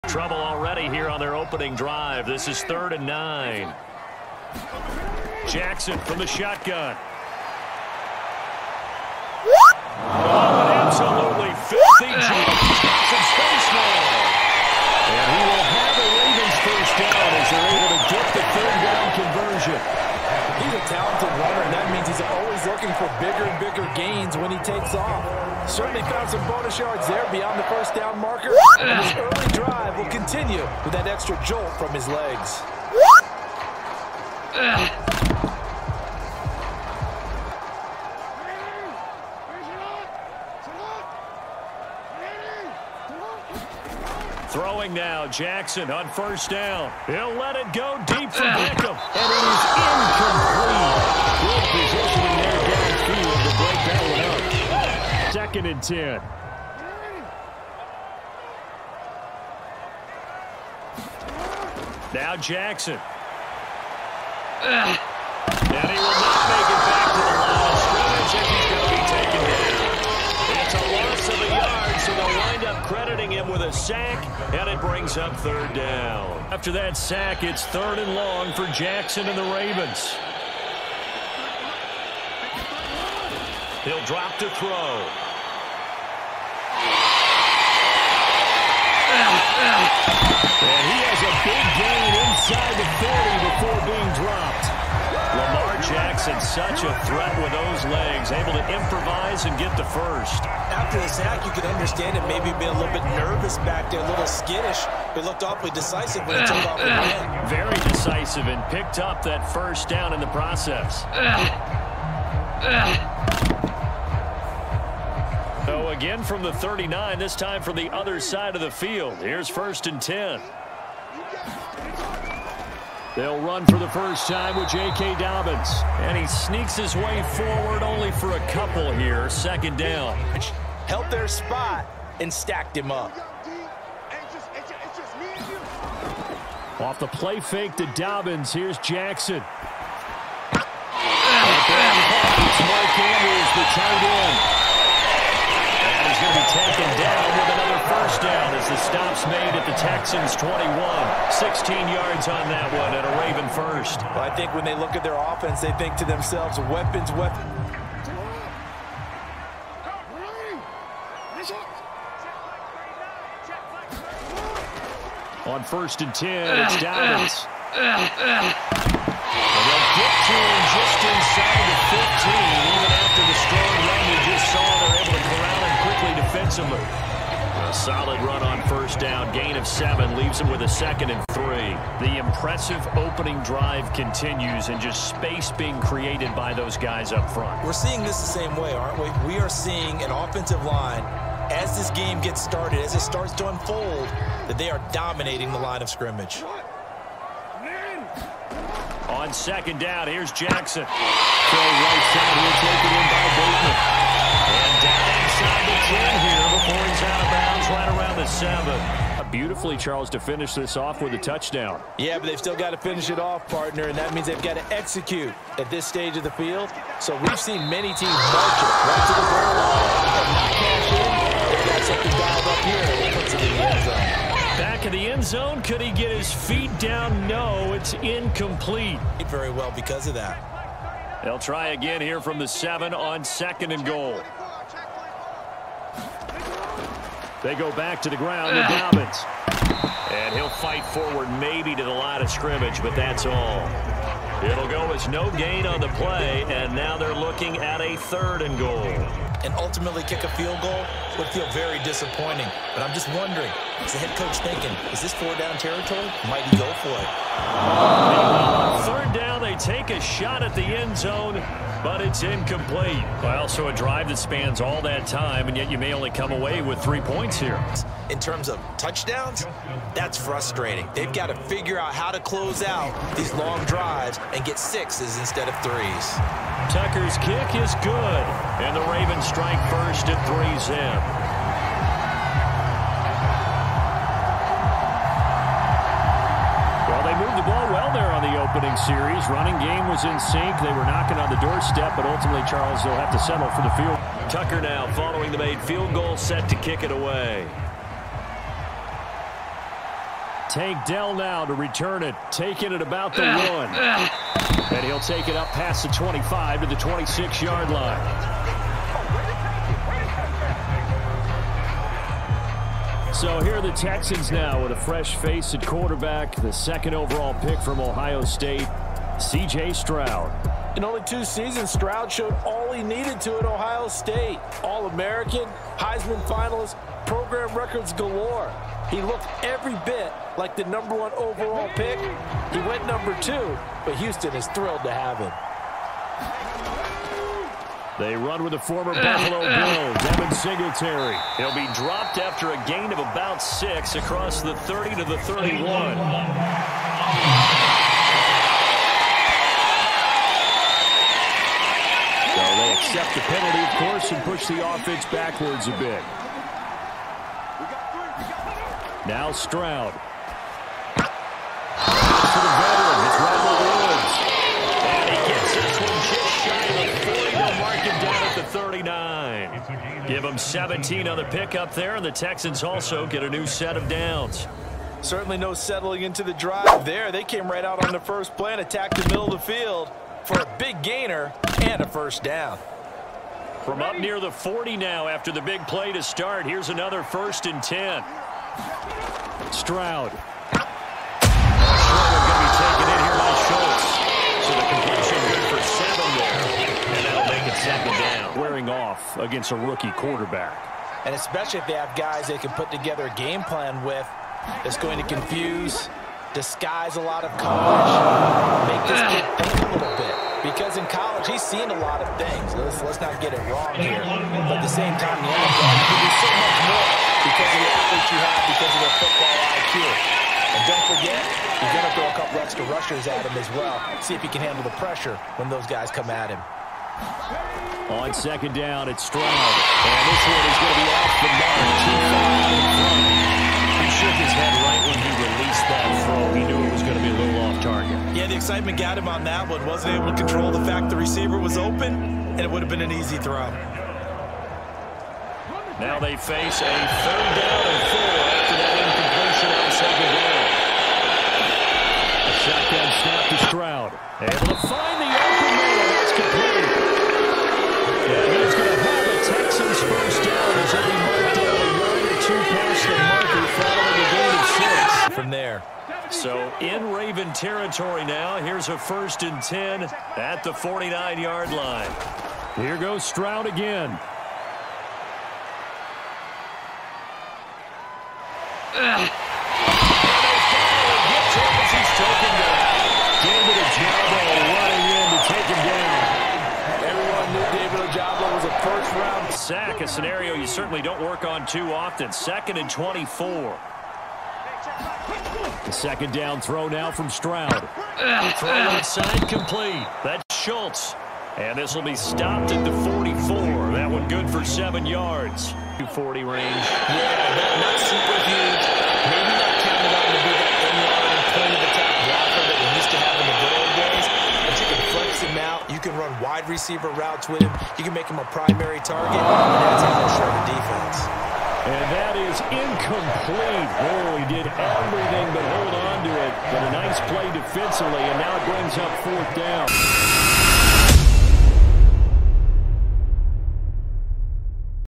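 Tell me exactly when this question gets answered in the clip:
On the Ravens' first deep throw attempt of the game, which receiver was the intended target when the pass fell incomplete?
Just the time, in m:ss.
0:48.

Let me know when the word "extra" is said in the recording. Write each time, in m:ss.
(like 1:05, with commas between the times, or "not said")
0:31, 7:02.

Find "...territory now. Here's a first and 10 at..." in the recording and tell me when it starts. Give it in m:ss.
7:47.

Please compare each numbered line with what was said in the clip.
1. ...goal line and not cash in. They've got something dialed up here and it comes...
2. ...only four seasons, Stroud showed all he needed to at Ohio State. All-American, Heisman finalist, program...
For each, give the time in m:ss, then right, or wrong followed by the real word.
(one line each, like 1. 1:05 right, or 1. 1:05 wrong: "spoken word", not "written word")
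1. 3:39 right
2. 5:20 wrong: "two", not "four".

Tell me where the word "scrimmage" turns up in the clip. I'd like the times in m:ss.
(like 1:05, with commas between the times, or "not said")
1:08, 3:15, 4:02.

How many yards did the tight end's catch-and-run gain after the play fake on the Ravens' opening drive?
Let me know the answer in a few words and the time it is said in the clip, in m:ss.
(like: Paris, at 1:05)
16, at 2:31.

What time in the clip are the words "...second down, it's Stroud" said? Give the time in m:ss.
7:08.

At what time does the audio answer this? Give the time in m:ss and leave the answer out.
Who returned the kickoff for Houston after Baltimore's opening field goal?
5:00.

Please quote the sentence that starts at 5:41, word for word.
He'll be dropped after a gain of about six across the 30 to the 31.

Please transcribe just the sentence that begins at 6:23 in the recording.
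From up near the 40 now after the big play to start, here's another first and 10.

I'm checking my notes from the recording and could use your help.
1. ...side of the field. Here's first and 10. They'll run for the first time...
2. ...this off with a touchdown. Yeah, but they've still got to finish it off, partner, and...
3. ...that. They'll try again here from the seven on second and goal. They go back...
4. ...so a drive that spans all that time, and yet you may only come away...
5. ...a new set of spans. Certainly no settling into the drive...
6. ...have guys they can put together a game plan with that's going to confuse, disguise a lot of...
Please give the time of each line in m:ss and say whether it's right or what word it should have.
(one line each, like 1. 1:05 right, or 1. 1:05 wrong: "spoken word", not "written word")
1. 1:58 right
2. 3:30 right
3. 3:50 right
4. 4:23 right
5. 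6:13 wrong: "downs", not "spans"
6. 6:41 right.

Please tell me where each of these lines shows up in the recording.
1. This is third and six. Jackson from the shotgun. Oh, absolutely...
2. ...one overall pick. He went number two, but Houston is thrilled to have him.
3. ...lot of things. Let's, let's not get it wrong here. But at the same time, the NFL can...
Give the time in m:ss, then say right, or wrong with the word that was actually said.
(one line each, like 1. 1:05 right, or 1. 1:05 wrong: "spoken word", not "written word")
1. 0:02 wrong: "nine", not "six"
2. 5:30 right
3. 6:51 right.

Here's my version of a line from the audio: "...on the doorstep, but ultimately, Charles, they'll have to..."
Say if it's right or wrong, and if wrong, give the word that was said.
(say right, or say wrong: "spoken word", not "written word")
right.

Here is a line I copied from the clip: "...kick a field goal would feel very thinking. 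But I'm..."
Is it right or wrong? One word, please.
wrong.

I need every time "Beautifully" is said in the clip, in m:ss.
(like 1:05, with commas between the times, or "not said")
3:29.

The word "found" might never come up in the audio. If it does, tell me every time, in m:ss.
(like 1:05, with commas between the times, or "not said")
0:26.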